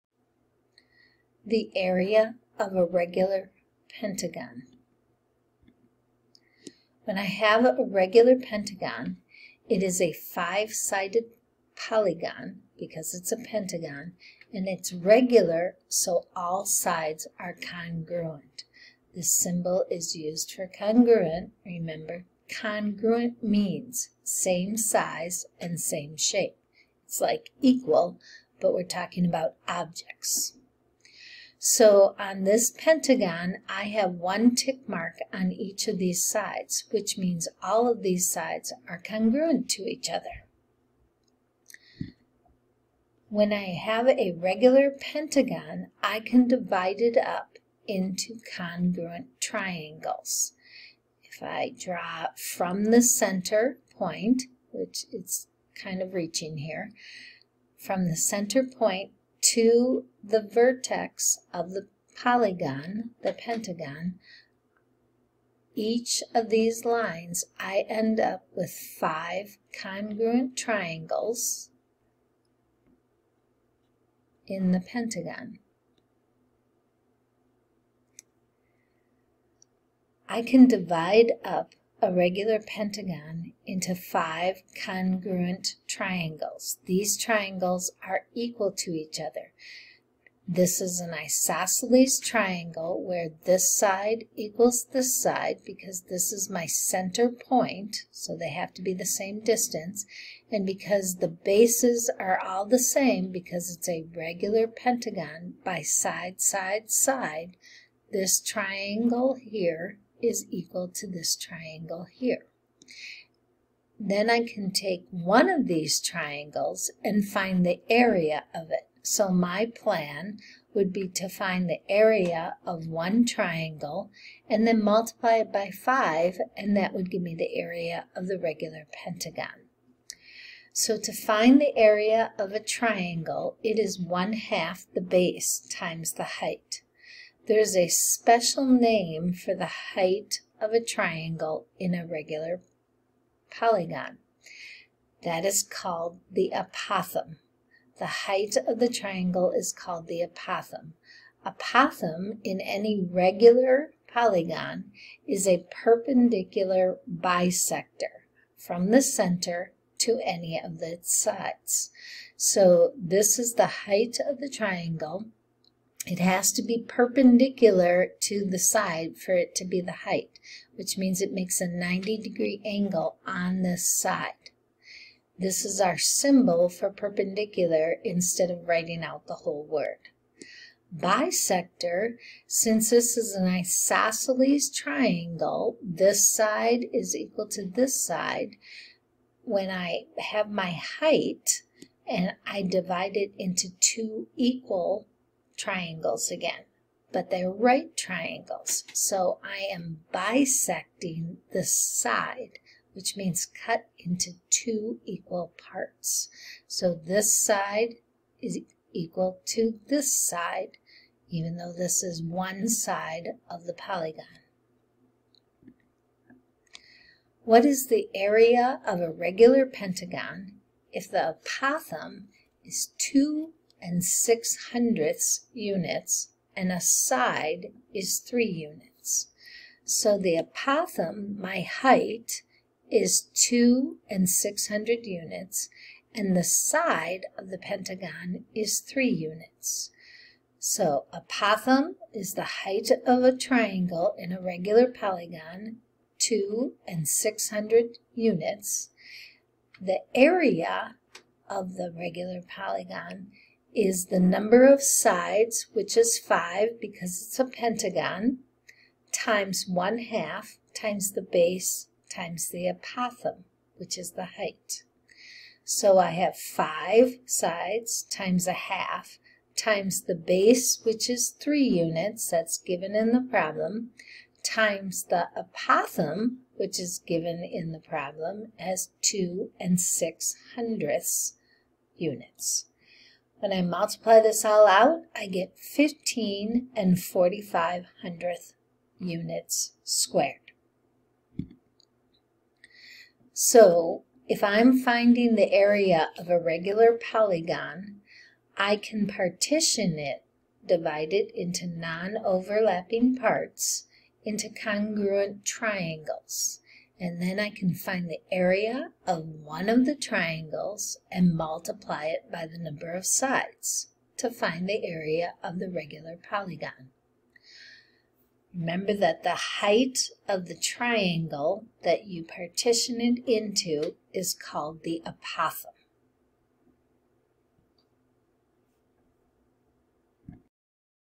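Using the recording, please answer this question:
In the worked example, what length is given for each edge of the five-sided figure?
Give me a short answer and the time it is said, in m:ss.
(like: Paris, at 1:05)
3 units, at 3:46.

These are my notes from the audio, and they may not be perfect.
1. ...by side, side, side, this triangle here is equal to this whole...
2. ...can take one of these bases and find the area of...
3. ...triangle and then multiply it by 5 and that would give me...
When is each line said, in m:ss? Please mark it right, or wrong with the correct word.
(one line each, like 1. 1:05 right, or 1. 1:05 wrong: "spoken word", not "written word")
1. 1:45 wrong: "triangle", not "whole"
2. 1:54 wrong: "triangles", not "bases"
3. 2:03 right.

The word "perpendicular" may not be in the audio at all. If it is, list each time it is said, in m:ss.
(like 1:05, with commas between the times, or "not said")
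2:35, 2:46, 2:56.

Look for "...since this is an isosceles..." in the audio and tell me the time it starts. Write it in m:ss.
3:02.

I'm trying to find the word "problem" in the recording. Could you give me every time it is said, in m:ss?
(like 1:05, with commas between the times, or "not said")
4:33, 4:37.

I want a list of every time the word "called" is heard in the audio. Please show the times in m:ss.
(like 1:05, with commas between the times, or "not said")
2:25, 2:29, 5:24.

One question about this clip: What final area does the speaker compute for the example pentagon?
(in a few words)
15.45 square units.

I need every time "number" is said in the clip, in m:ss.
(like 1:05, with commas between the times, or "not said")
4:14, 5:12.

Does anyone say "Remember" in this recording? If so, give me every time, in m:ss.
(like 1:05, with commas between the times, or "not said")
0:21, 5:18.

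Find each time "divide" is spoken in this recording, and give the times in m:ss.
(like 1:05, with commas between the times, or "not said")
0:46, 1:20, 3:12, 5:00.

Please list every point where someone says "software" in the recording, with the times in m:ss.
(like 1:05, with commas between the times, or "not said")
not said.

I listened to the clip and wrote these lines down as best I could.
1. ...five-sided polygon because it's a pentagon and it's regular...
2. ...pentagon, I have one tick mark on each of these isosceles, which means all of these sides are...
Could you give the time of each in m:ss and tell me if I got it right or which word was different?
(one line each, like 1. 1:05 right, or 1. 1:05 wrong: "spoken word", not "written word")
1. 0:10 right
2. 0:32 wrong: "sides", not "isosceles".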